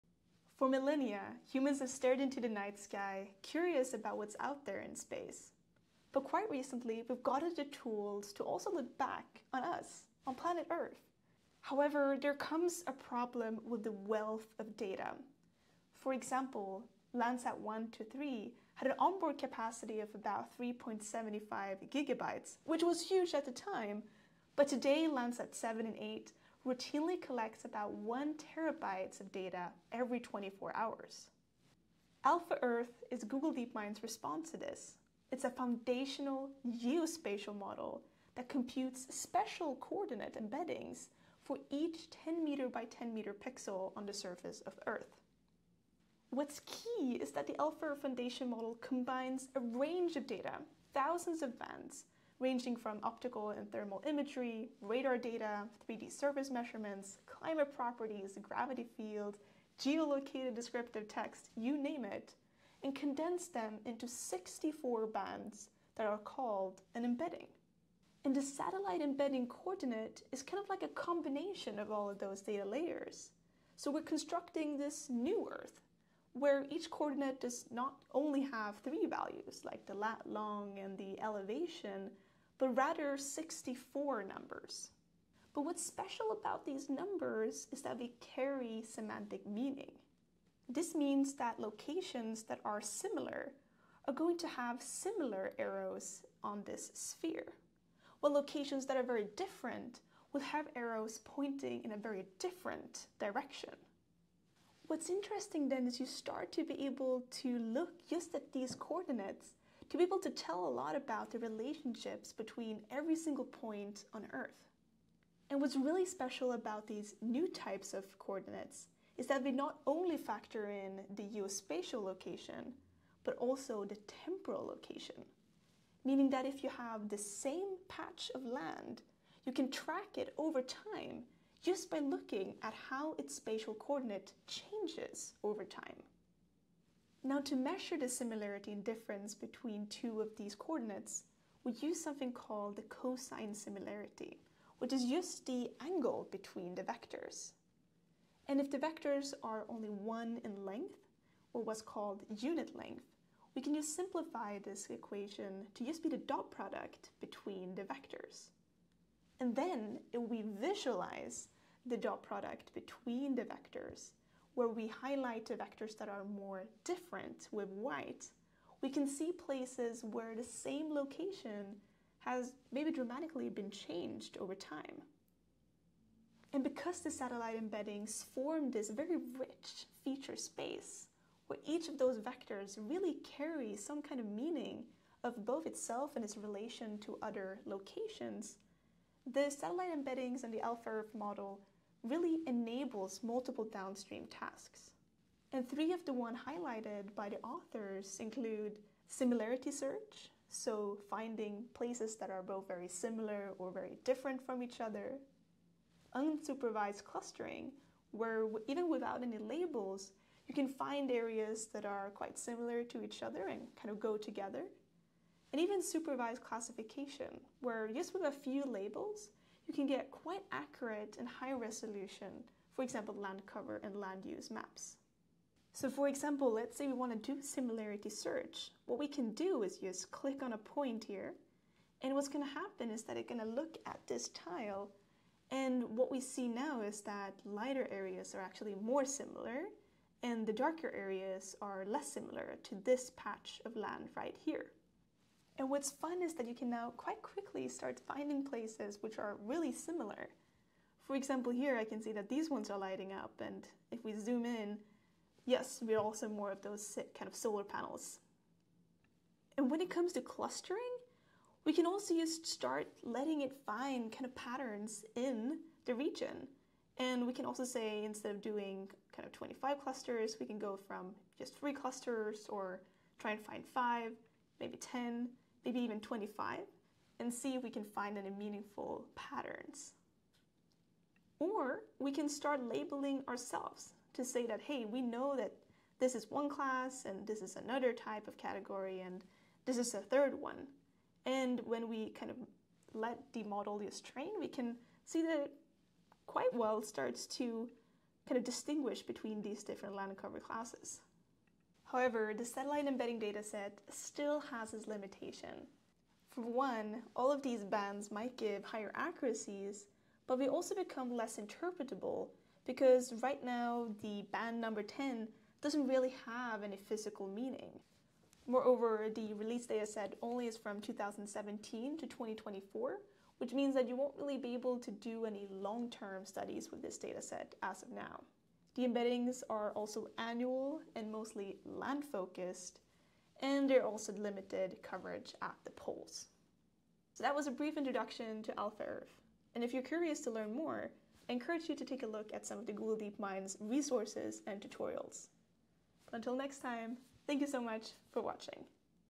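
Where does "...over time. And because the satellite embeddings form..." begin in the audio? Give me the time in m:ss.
2:54.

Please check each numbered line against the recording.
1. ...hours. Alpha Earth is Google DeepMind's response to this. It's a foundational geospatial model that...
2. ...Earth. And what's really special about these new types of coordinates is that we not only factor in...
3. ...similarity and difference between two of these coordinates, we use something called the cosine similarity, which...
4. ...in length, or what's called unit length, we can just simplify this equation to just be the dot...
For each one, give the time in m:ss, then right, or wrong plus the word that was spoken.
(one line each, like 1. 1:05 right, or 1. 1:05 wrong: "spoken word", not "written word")
1. 0:30 right
2. 1:54 right
3. 2:18 right
4. 2:30 right.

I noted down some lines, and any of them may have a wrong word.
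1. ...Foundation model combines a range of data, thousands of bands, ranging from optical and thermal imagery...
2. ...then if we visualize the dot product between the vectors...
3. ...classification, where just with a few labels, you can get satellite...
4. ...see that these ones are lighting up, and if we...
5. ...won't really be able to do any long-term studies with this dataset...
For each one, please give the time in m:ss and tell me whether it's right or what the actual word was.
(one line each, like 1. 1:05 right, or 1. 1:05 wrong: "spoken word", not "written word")
1. 0:48 right
2. 2:39 right
3. 3:36 wrong: "quite", not "satellite"
4. 4:12 right
5. 5:23 right.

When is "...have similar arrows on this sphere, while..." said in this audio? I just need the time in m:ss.
1:34.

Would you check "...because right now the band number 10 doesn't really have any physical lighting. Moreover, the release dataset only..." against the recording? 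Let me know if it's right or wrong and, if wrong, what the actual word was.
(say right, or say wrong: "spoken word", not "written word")
wrong: "meaning", not "lighting".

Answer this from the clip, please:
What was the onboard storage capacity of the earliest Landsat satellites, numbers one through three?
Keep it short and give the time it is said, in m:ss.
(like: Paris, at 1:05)
3.75 gigabytes, at 0:20.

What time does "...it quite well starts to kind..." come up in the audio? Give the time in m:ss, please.
4:55.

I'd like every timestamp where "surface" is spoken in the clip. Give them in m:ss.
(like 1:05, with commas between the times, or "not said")
0:44, 0:56.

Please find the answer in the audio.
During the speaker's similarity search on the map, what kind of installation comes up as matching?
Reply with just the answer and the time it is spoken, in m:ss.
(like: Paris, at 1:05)
solar panels, at 4:17.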